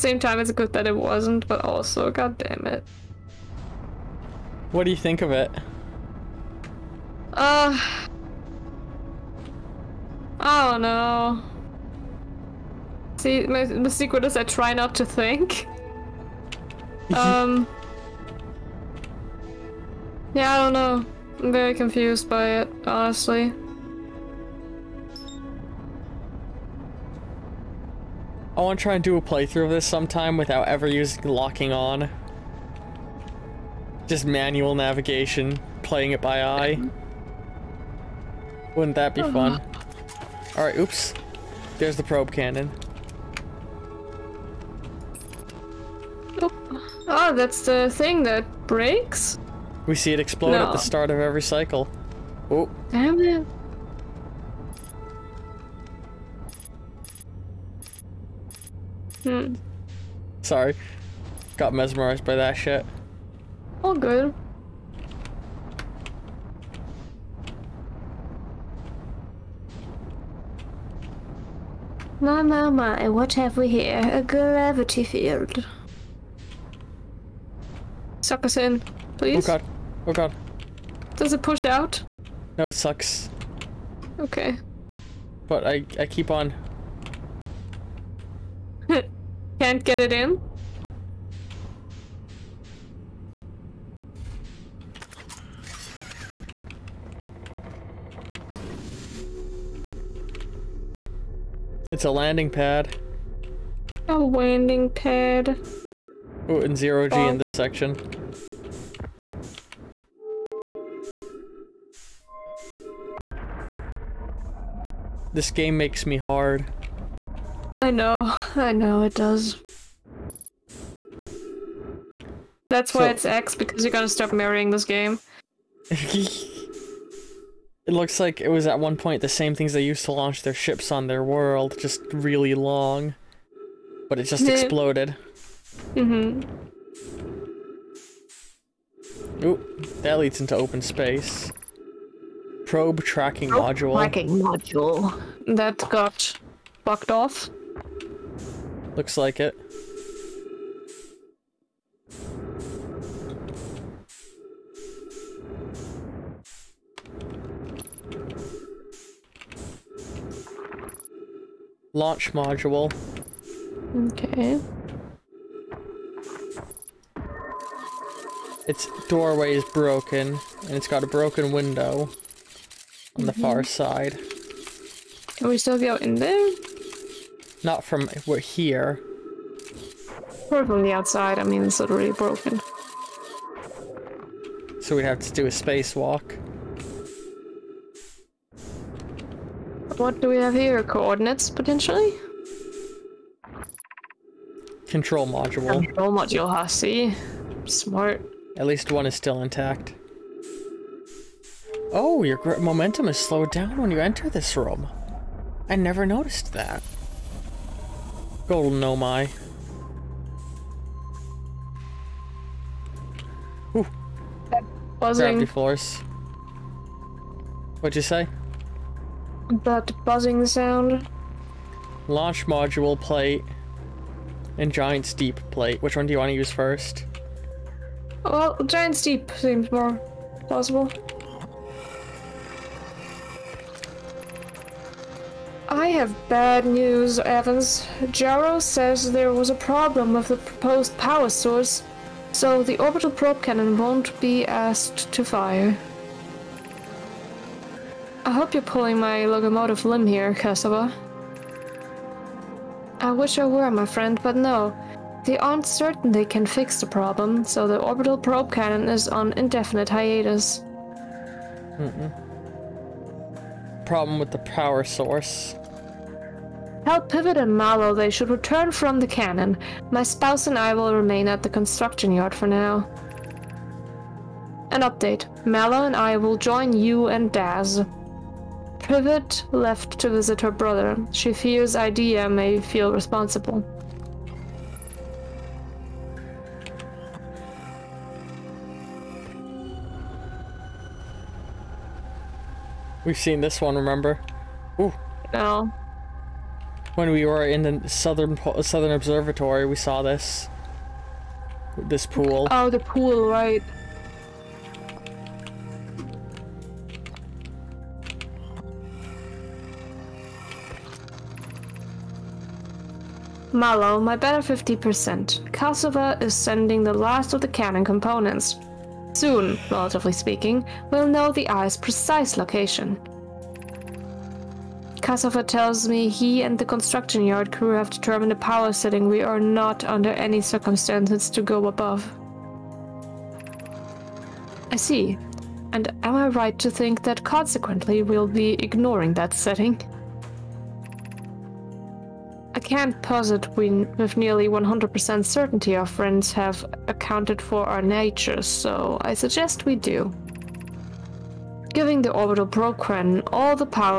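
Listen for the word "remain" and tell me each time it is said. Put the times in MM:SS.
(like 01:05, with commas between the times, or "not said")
04:30.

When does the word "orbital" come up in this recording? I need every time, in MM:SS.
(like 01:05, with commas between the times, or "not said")
04:02, 04:17, 05:52.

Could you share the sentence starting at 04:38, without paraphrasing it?
Privet left to visit her brother.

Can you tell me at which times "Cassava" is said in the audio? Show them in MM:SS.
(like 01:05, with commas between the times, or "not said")
05:15, 05:25.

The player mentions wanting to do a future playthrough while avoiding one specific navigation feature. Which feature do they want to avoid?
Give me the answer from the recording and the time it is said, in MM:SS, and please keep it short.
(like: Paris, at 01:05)
locking on, at 00:31.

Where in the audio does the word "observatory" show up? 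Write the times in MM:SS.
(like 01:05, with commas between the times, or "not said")
04:58.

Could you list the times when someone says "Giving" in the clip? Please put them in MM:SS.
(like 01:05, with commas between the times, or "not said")
05:51.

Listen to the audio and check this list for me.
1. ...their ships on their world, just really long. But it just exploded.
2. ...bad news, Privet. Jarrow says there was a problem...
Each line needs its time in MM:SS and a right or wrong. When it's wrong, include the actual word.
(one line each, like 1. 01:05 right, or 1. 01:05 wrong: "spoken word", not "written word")
1. 02:10 right
2. 03:56 wrong: "Evans", not "Privet".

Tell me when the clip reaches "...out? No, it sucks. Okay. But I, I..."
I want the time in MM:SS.
01:21.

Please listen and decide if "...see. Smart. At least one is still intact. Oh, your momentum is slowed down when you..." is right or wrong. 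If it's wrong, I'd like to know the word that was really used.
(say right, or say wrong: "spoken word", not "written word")
right.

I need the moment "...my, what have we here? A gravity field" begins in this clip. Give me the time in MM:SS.
01:12.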